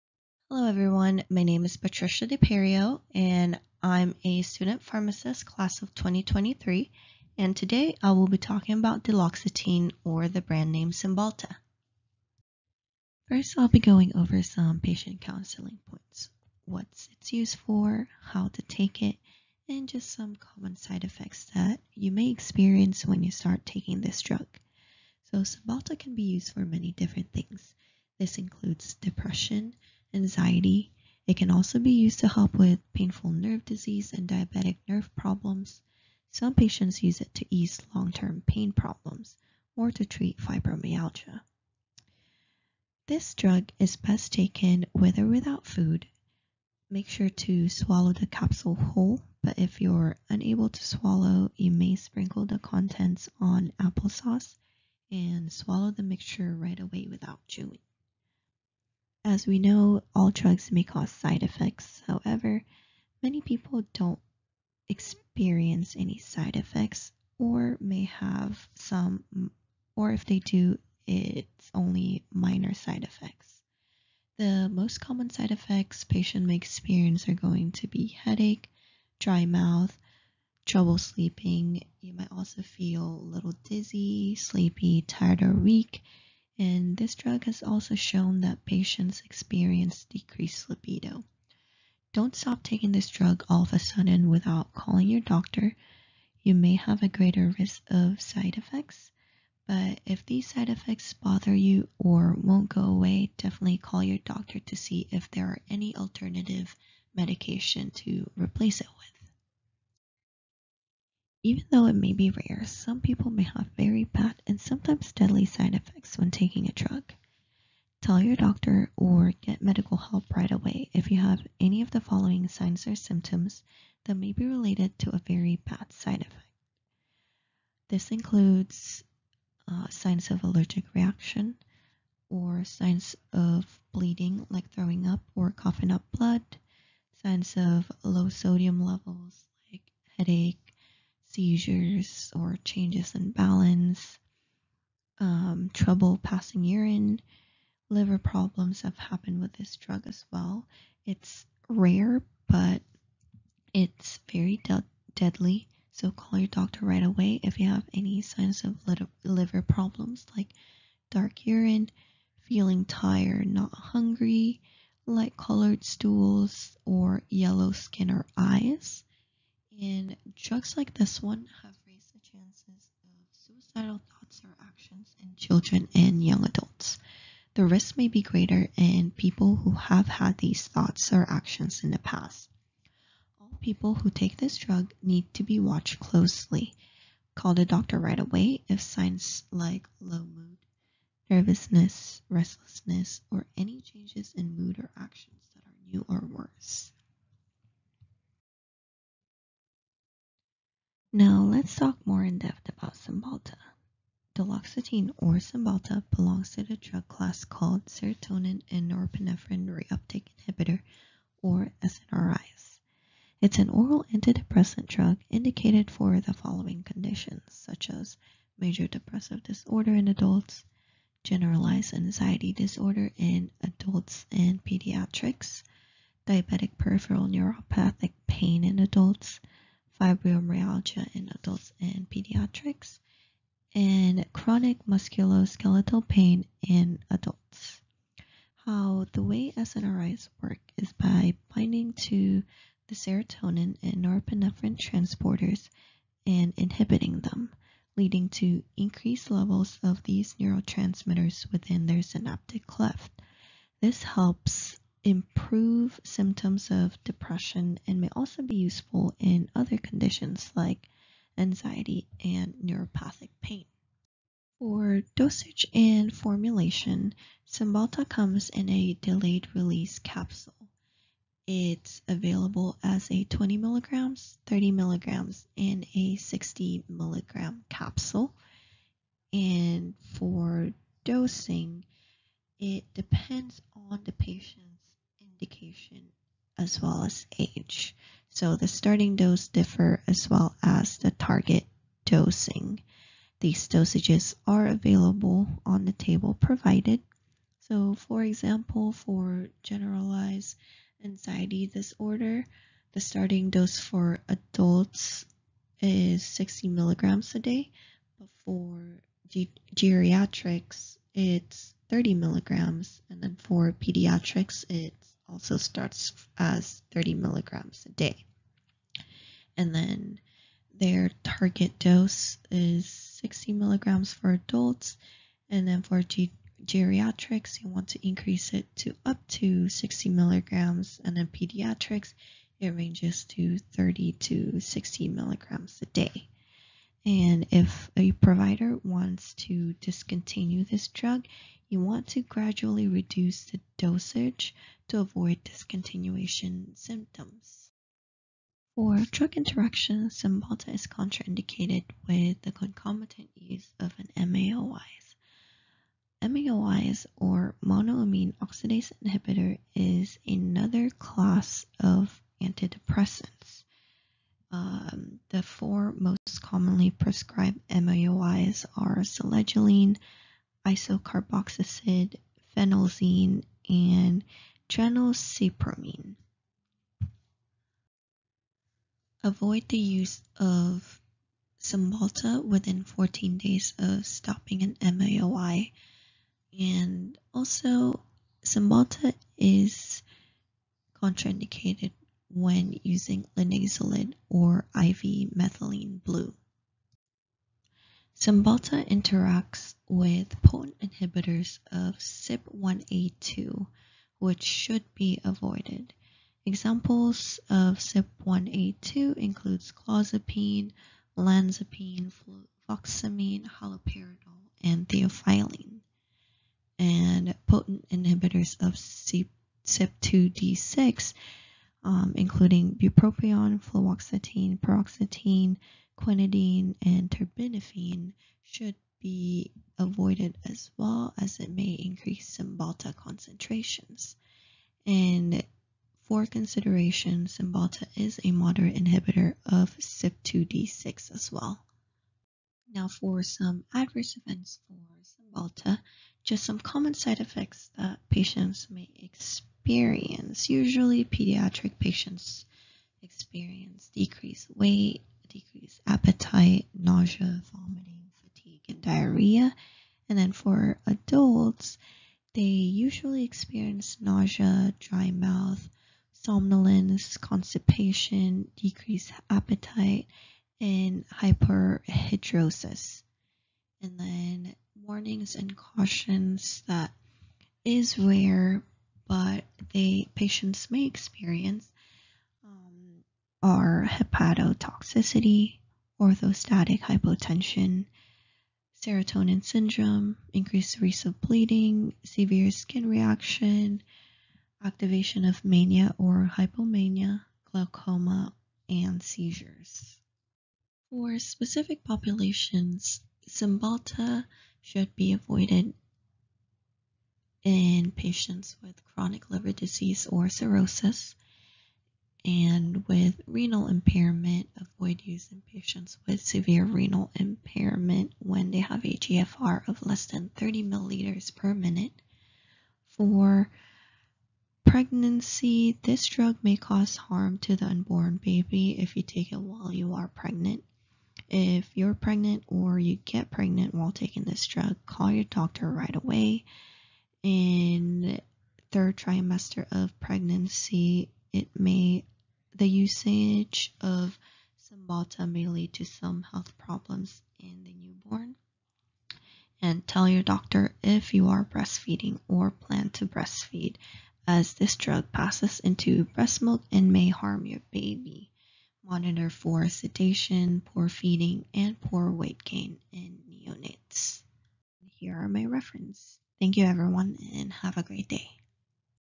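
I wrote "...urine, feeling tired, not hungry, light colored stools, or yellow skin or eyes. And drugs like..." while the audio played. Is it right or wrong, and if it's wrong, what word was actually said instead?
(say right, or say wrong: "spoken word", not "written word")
right.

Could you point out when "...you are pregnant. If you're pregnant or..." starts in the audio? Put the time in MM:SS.
08:49.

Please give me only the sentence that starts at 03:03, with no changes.
All people who take this drug need to be watched closely.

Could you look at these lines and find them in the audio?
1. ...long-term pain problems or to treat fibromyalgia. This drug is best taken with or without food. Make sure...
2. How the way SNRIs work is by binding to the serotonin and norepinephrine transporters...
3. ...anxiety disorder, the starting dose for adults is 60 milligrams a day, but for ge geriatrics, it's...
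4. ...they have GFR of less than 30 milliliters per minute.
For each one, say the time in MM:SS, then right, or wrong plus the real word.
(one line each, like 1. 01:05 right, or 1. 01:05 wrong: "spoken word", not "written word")
1. 00:37 right
2. 03:58 right
3. 05:01 right
4. 08:38 right.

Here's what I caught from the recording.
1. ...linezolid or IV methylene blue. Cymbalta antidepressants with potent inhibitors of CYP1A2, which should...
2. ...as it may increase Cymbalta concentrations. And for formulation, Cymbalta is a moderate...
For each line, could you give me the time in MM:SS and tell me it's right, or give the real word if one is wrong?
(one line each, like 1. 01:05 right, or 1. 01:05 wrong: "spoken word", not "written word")
1. 06:33 wrong: "interacts", not "antidepressants"
2. 07:11 wrong: "consideration", not "formulation".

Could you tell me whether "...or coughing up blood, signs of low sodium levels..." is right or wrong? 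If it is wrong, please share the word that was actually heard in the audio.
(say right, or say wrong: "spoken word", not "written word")
right.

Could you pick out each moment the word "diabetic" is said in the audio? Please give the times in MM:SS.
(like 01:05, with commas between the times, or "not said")
00:34, 03:46.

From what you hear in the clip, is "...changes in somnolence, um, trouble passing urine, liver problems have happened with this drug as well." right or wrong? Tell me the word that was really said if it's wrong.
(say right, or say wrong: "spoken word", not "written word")
wrong: "balance", not "somnolence".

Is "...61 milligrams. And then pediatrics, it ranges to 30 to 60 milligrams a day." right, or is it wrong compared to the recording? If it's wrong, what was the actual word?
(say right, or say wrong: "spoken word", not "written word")
wrong: "60", not "61".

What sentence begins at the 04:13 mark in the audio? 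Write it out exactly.
This helps improve symptoms of depression and may also be useful in other conditions like anxiety and neuropathic pain.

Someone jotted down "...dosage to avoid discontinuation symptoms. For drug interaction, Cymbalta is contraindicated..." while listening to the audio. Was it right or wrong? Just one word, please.
right.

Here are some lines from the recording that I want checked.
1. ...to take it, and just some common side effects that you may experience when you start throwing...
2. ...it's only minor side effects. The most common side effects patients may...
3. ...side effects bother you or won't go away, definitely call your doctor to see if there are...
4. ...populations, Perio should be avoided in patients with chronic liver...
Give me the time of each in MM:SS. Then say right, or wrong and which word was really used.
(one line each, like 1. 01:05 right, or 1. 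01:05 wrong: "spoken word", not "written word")
1. 00:18 wrong: "taking", not "throwing"
2. 01:11 right
3. 01:40 right
4. 08:21 wrong: "Cymbalta", not "Perio".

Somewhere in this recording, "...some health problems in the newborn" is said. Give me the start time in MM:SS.
09:05.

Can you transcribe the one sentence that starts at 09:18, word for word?
Monitor for sedation, poor feeding, and poor weight gain in neonates.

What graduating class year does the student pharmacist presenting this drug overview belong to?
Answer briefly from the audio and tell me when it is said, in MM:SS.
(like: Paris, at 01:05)
2023, at 00:05.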